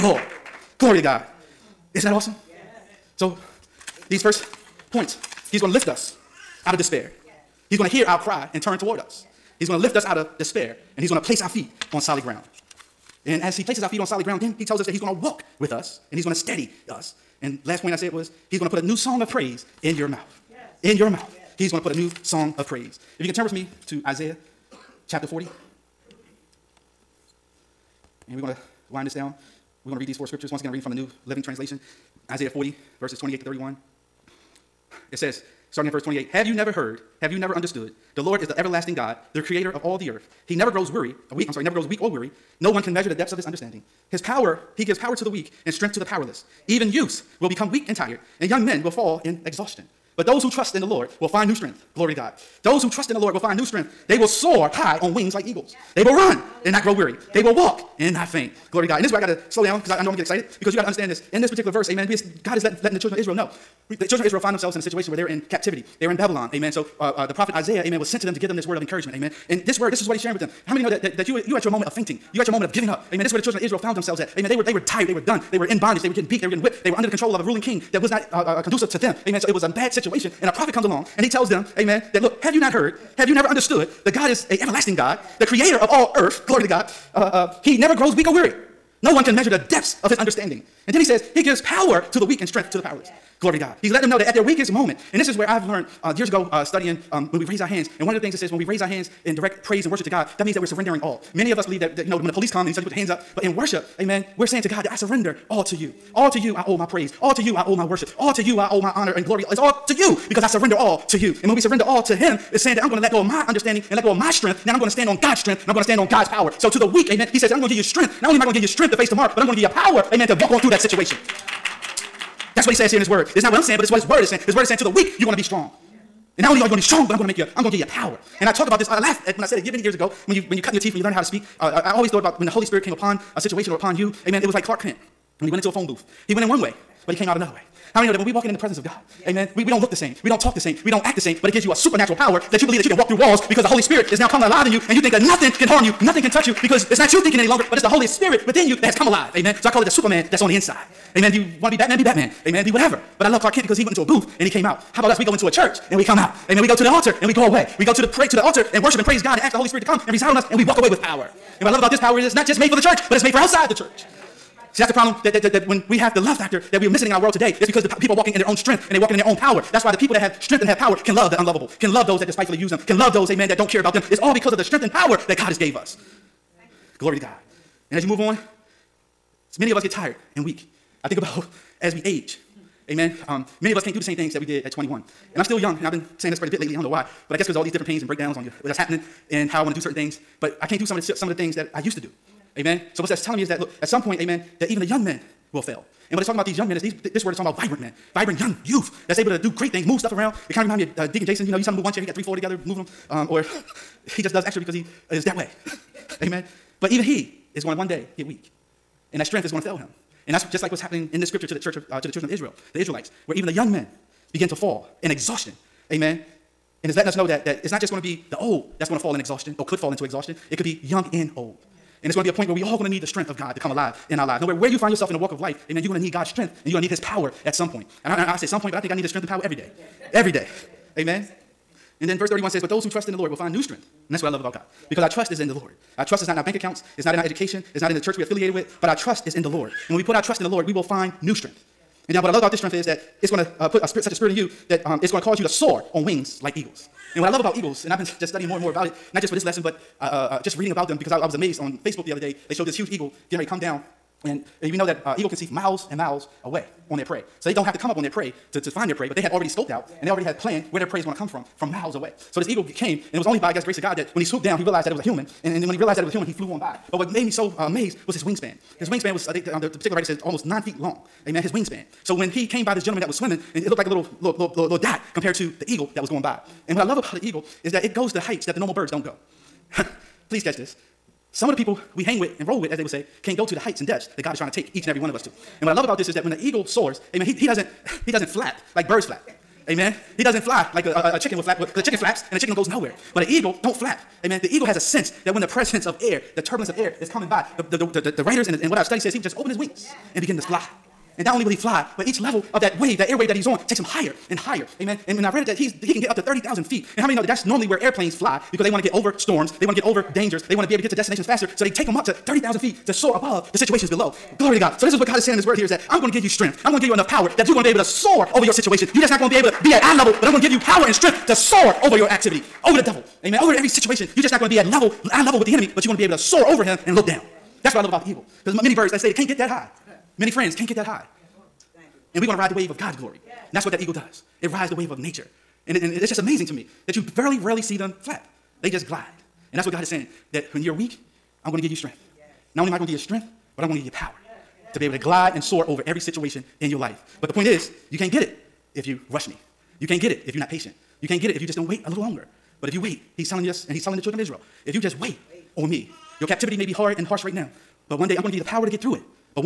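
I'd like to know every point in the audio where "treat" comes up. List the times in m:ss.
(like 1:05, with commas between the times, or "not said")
not said.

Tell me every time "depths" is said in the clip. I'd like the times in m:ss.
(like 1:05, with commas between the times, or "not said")
0:43, 1:29, 4:43.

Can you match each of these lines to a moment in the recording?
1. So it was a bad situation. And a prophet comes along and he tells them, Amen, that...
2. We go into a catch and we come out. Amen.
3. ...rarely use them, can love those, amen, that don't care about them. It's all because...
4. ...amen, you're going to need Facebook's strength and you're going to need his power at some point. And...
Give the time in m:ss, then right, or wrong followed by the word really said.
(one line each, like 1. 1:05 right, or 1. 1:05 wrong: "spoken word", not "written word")
1. 1:19 right
2. 2:35 wrong: "church", not "catch"
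3. 2:52 wrong: "despitefully", not "rarely"
4. 3:45 wrong: "God", not "Facebook".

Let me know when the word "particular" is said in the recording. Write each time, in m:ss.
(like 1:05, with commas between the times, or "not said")
1:01, 4:29.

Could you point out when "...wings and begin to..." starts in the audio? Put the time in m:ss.
4:59.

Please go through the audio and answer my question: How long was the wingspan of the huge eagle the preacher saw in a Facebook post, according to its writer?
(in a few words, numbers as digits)
almost 9 feet.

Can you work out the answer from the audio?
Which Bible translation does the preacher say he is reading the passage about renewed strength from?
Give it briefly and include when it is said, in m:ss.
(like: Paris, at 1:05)
New Living Translation, at 0:30.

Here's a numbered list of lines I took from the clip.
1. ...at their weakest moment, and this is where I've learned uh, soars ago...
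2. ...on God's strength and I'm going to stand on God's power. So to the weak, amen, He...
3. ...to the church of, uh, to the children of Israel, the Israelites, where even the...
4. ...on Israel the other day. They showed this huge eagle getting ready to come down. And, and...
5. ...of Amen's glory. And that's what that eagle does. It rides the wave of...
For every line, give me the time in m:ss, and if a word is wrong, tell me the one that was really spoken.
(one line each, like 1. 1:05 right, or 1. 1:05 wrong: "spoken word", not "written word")
1. 1:34 wrong: "years", not "soars"
2. 1:55 right
3. 3:31 right
4. 4:11 wrong: "Facebook", not "Israel"
5. 5:32 wrong: "God", not "Amen".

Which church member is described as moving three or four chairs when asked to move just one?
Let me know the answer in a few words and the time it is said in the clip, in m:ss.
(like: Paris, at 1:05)
Deacon Jason, at 3:21.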